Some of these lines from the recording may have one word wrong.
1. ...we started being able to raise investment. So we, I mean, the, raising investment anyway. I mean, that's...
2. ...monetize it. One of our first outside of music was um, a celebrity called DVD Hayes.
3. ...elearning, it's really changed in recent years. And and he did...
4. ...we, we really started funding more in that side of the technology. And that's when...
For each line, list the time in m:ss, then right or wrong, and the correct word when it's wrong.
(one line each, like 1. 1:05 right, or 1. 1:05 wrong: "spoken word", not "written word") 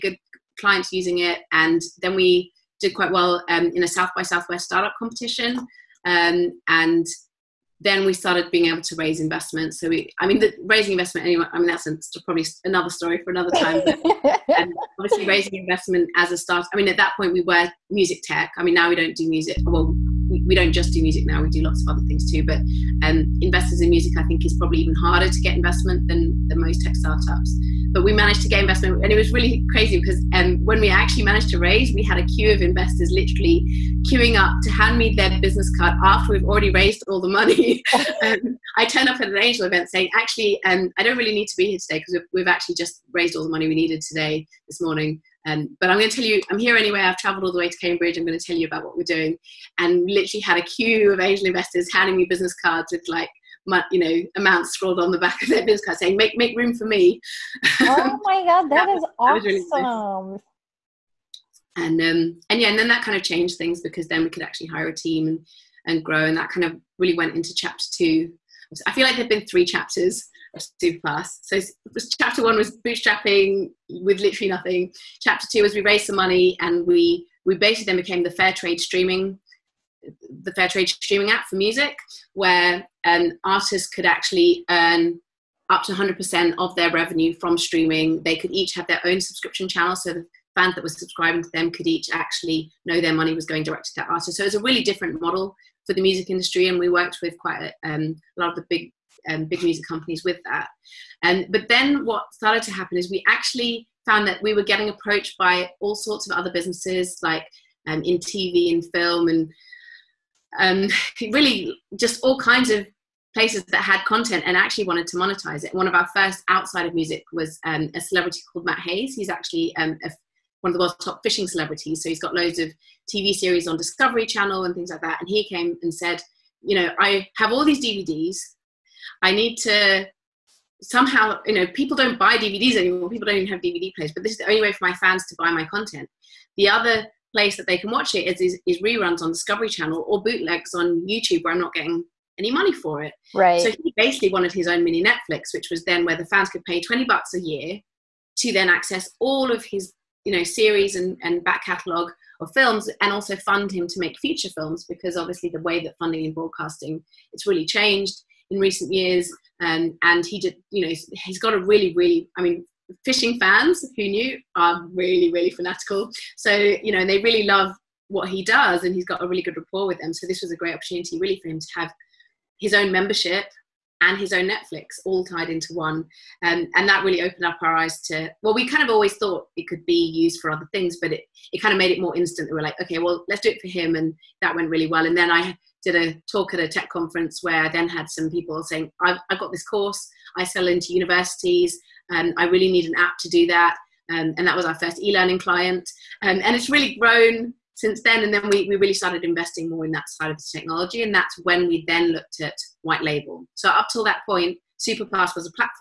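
1. 0:08 right
2. 1:55 wrong: "Matt", not "DVD"
3. 2:36 wrong: "broadcasting", not "elearning"
4. 3:18 wrong: "investing", not "funding".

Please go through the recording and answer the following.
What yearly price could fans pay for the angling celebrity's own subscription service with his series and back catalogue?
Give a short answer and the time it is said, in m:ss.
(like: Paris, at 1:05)
20 bucks, at 2:26.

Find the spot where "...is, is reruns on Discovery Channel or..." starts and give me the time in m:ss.
2:18.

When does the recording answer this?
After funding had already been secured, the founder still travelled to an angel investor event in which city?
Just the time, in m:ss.
0:47.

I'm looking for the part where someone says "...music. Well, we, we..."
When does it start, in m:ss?
0:19.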